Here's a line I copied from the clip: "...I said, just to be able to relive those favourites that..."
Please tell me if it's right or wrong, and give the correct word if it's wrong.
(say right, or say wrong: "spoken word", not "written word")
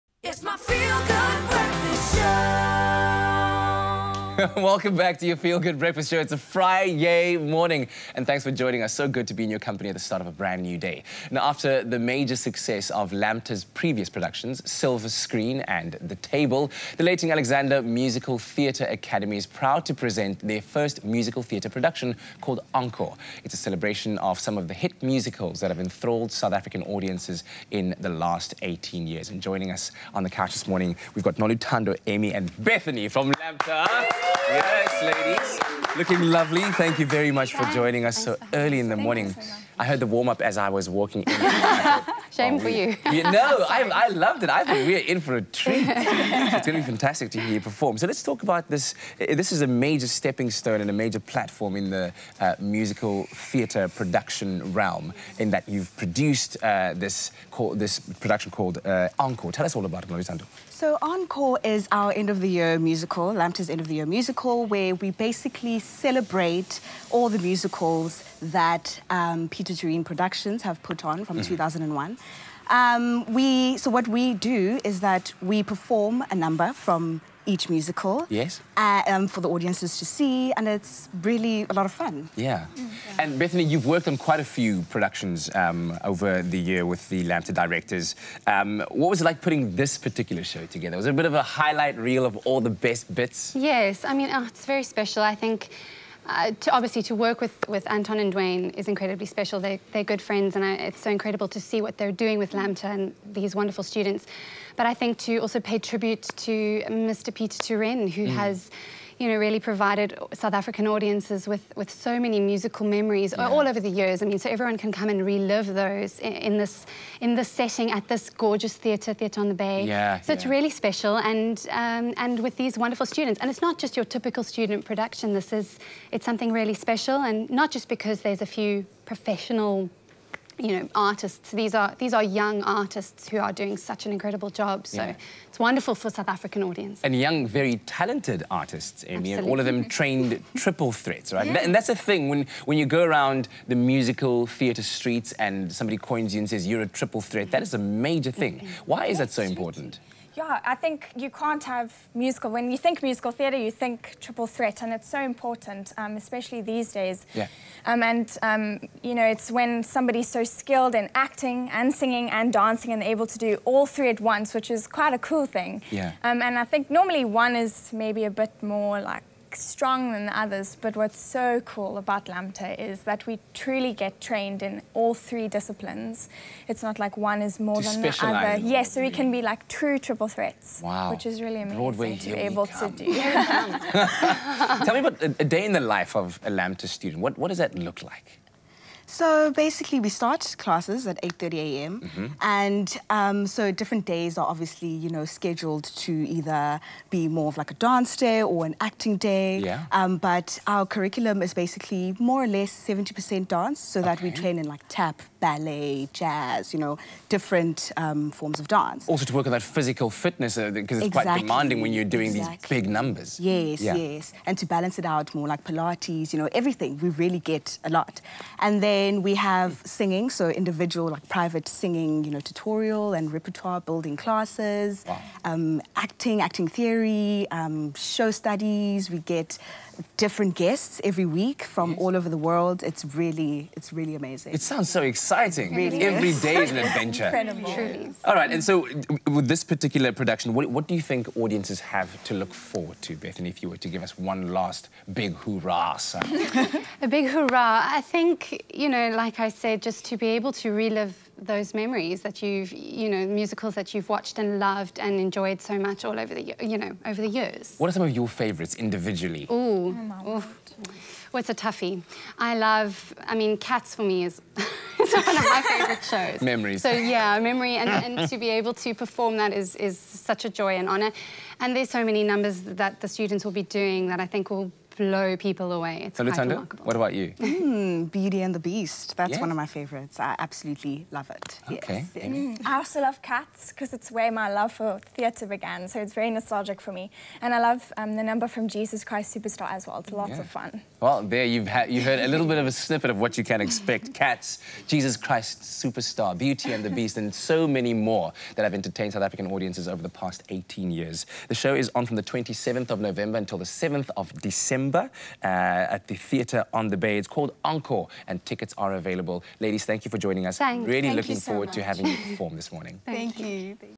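wrong: "memories", not "favourites".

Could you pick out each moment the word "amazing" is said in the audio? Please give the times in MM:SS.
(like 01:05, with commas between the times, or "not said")
03:01, 03:54.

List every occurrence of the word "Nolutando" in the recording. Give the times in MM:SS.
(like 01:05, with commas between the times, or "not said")
00:31, 01:00.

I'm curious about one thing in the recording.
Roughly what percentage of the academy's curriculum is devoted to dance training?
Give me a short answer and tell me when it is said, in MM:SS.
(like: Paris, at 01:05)
70%, at 03:22.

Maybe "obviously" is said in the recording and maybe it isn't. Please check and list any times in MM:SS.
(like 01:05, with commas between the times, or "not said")
01:36, 03:14.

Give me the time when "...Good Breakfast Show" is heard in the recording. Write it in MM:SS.
00:05.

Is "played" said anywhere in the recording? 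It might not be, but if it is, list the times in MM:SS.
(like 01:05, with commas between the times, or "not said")
not said.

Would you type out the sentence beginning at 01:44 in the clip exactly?
But I think to also pay tribute to Mr.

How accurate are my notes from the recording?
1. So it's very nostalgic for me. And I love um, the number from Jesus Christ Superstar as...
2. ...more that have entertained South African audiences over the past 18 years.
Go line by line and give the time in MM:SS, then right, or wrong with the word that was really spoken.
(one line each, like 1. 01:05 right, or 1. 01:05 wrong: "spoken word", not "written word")
1. 04:45 right
2. 04:57 right.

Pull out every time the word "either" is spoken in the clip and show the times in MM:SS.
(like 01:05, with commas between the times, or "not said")
03:16.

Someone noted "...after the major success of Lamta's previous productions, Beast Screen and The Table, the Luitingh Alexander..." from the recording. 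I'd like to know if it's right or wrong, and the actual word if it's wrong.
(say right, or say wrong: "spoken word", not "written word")
wrong: "Silver", not "Beast".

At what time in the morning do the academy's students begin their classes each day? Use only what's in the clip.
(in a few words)
8:30 a.m.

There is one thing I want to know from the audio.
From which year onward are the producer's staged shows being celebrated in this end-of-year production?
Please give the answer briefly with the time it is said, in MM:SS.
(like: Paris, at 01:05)
2001, at 01:11.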